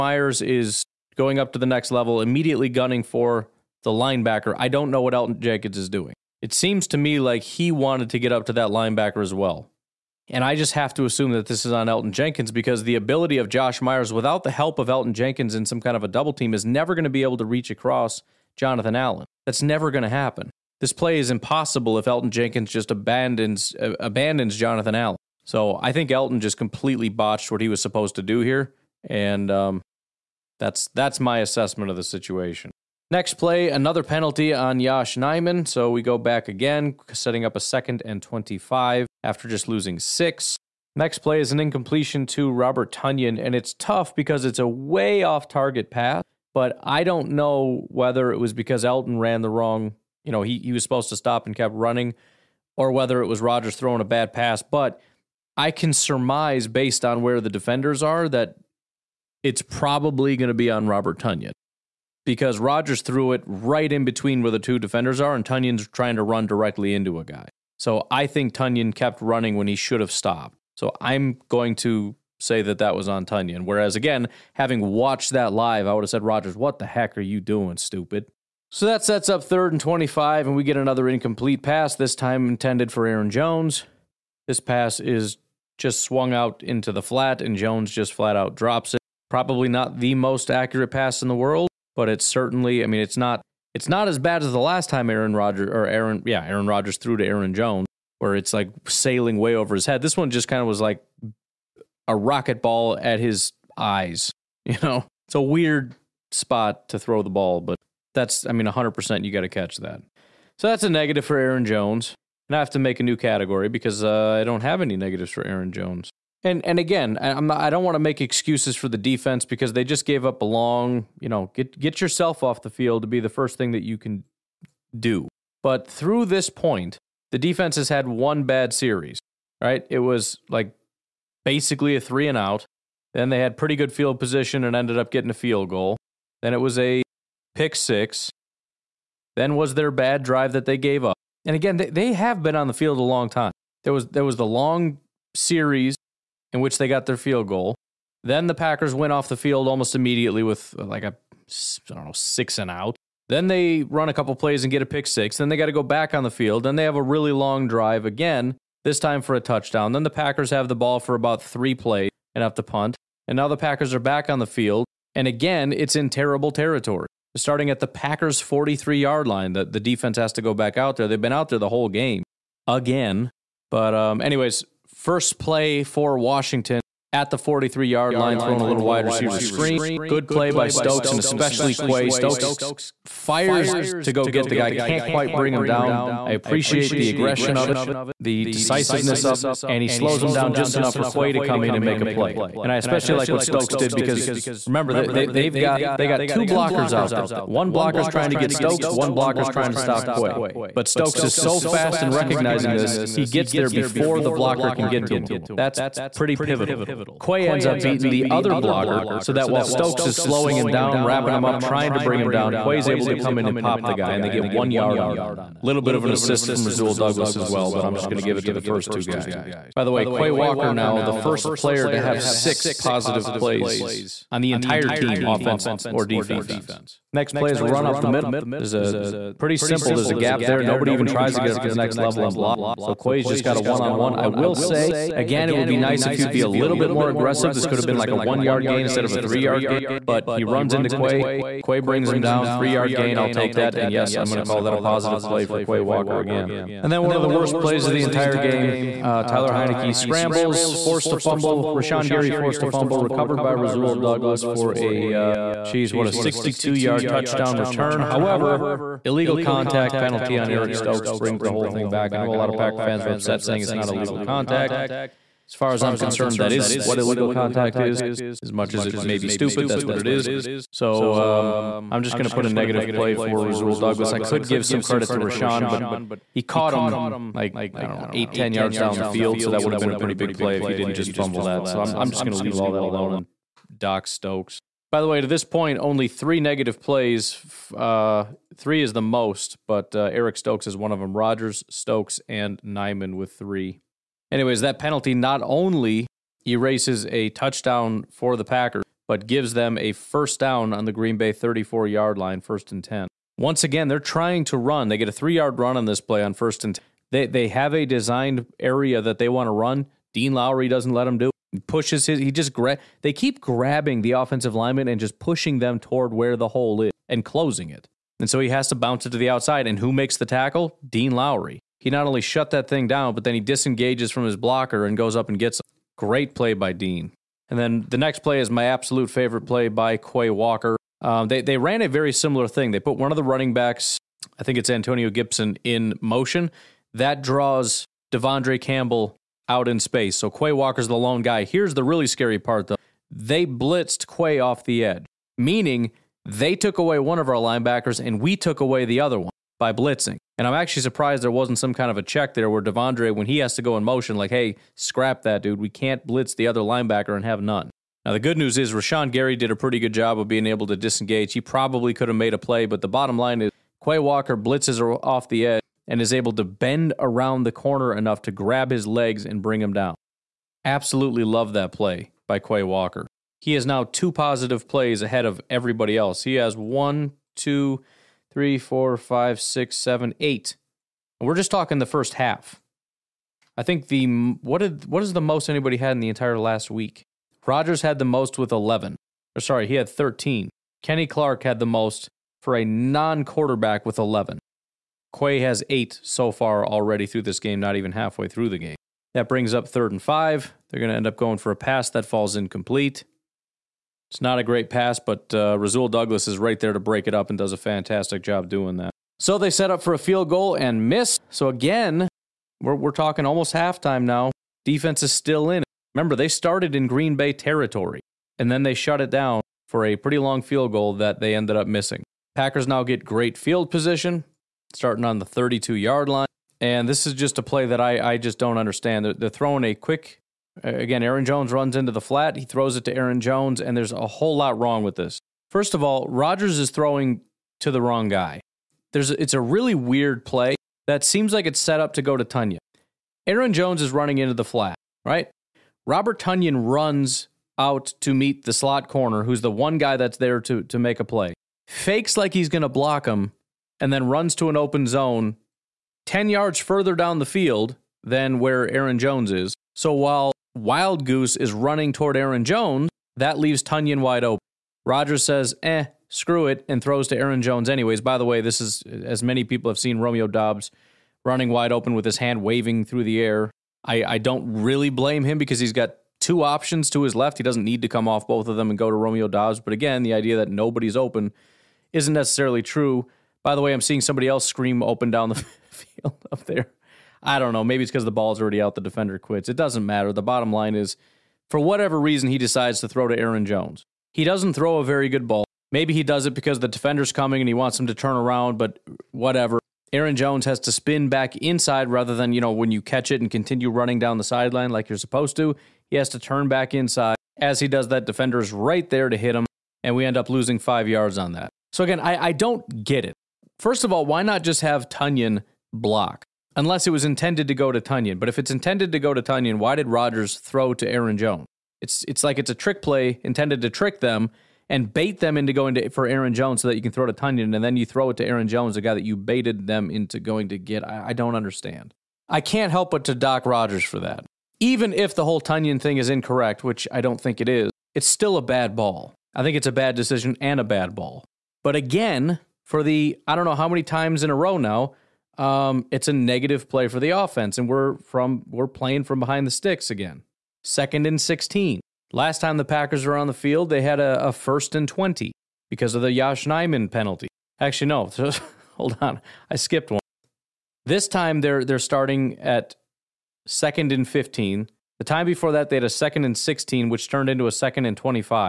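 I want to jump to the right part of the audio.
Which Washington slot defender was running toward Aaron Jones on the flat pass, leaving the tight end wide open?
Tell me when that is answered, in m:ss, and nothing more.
7:40.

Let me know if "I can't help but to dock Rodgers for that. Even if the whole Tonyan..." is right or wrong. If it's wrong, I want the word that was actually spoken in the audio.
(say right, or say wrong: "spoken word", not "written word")
right.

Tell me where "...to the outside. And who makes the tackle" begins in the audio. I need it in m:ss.
5:19.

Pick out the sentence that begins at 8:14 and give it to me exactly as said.
He doesn't throw a very good ball.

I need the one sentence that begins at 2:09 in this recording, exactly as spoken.
It was like basically a three and out.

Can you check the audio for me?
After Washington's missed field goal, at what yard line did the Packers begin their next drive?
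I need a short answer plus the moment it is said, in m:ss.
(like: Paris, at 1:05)
32 yard line, at 7:05.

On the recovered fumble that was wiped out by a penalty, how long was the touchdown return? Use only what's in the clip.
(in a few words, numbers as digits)
62 yards.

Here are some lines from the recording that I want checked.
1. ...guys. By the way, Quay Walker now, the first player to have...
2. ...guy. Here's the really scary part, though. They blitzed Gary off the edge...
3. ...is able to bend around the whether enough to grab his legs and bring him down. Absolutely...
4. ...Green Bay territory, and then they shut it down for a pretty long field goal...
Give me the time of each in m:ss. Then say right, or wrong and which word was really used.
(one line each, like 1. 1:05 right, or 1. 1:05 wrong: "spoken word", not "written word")
1. 3:39 right
2. 5:41 wrong: "Quay", not "Gary"
3. 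6:06 wrong: "corner", not "whether"
4. 6:56 right.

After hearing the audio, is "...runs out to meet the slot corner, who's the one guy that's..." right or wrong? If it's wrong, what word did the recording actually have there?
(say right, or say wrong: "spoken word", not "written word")
right.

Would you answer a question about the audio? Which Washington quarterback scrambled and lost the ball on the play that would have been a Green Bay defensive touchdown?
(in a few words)
Tyler Heinicke.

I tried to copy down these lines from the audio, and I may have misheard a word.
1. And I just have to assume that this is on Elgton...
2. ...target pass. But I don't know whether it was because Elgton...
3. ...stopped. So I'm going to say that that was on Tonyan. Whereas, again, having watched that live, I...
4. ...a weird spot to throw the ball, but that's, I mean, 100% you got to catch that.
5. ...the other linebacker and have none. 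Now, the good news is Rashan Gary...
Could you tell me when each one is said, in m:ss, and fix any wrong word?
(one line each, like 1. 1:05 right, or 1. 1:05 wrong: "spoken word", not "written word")
1. 0:10 right
2. 0:45 right
3. 1:10 right
4. 1:45 right
5. 5:56 right.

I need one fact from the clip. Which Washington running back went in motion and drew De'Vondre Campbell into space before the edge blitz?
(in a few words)
Antonio Gibson.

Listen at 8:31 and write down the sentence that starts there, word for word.
So again, I, I don't get it.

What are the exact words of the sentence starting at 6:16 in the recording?
He has one, two, three, four, five, six, seven, eight.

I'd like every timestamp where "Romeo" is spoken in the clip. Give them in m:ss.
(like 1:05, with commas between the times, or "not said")
7:49, 7:58.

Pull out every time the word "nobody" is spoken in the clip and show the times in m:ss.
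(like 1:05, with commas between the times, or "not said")
3:50, 8:00.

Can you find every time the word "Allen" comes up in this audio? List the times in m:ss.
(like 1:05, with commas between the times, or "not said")
0:18, 0:24.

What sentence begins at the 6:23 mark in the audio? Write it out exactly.
I think the what did what is the most anybody had in the entire last week?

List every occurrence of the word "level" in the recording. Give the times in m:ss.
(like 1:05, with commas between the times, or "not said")
0:01, 3:51.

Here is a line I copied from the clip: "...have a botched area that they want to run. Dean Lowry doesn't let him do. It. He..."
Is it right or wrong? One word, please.
wrong.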